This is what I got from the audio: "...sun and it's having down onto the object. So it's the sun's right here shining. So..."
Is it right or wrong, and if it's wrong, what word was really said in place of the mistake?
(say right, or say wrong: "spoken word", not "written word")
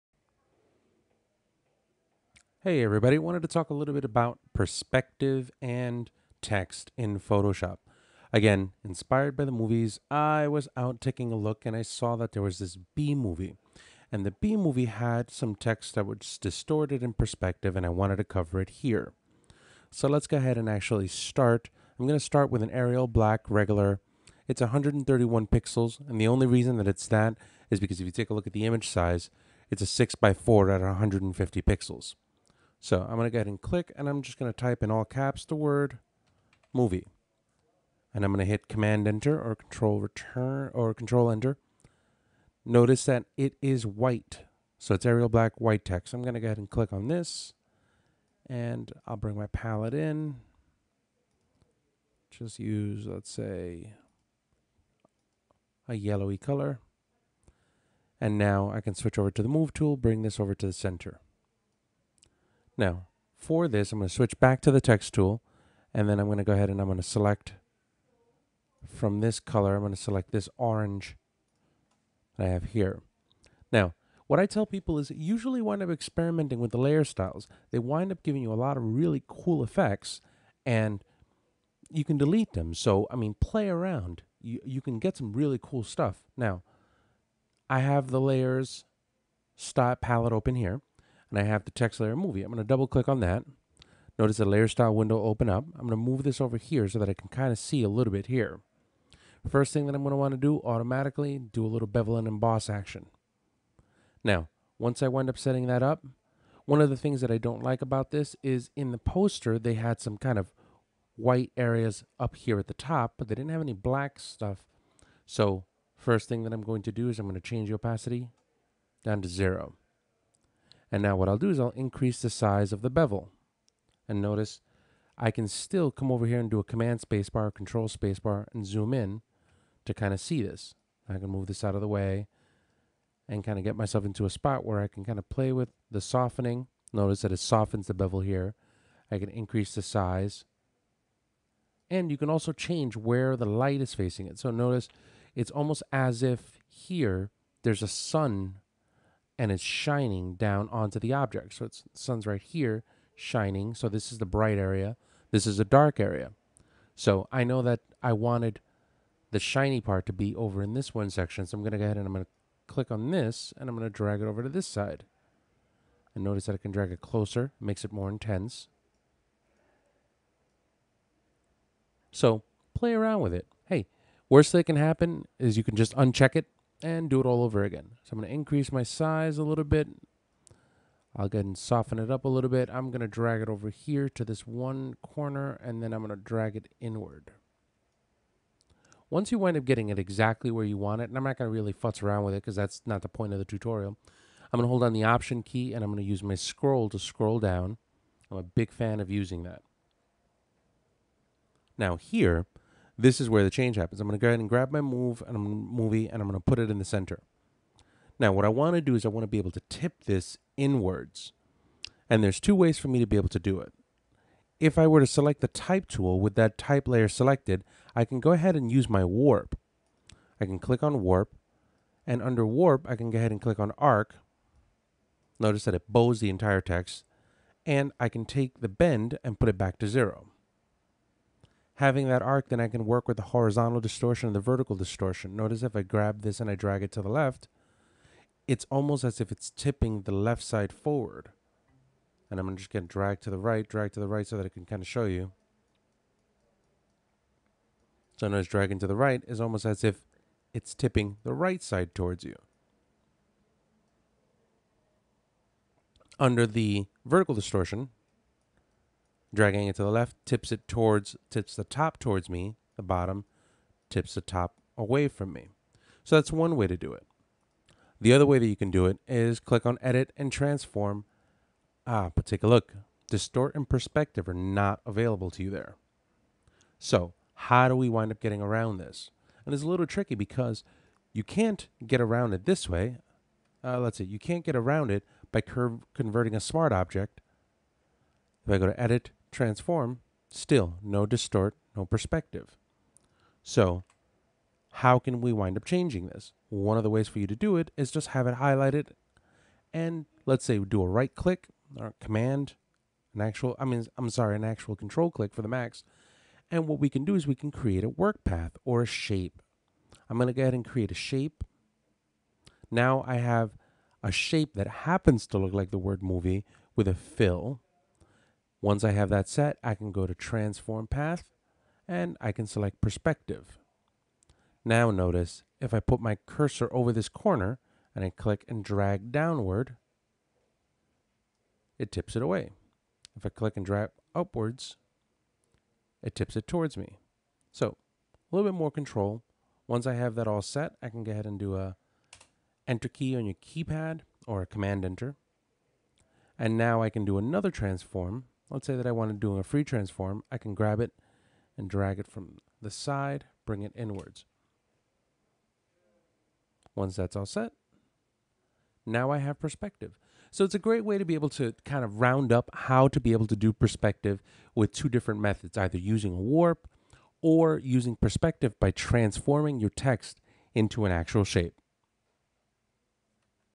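wrong: "shining", not "having".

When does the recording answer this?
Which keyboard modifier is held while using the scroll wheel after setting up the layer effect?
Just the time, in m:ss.
3:15.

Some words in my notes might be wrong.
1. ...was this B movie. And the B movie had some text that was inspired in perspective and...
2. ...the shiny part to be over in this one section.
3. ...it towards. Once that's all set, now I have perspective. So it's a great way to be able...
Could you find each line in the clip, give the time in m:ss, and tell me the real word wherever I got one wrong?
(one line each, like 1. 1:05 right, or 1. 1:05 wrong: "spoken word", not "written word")
1. 0:12 wrong: "distorted", not "inspired"
2. 2:39 right
3. 5:53 wrong: "inwards", not "towards".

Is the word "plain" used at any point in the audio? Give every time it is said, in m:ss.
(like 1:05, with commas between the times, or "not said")
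not said.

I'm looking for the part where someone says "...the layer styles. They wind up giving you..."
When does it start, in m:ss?
1:16.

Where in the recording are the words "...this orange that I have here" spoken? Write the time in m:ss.
1:10.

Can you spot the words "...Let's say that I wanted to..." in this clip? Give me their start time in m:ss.
5:48.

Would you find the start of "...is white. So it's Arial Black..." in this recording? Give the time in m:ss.
0:43.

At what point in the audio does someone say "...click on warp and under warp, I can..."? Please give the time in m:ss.
3:40.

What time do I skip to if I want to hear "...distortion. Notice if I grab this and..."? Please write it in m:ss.
3:54.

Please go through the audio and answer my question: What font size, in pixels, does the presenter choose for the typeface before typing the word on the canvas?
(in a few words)
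131.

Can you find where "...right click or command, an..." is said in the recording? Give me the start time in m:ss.
5:00.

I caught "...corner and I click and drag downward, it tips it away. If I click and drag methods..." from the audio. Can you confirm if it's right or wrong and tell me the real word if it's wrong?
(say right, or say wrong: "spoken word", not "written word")
wrong: "upwards", not "methods".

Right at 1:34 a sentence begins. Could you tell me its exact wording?
Notice the layer style window open up.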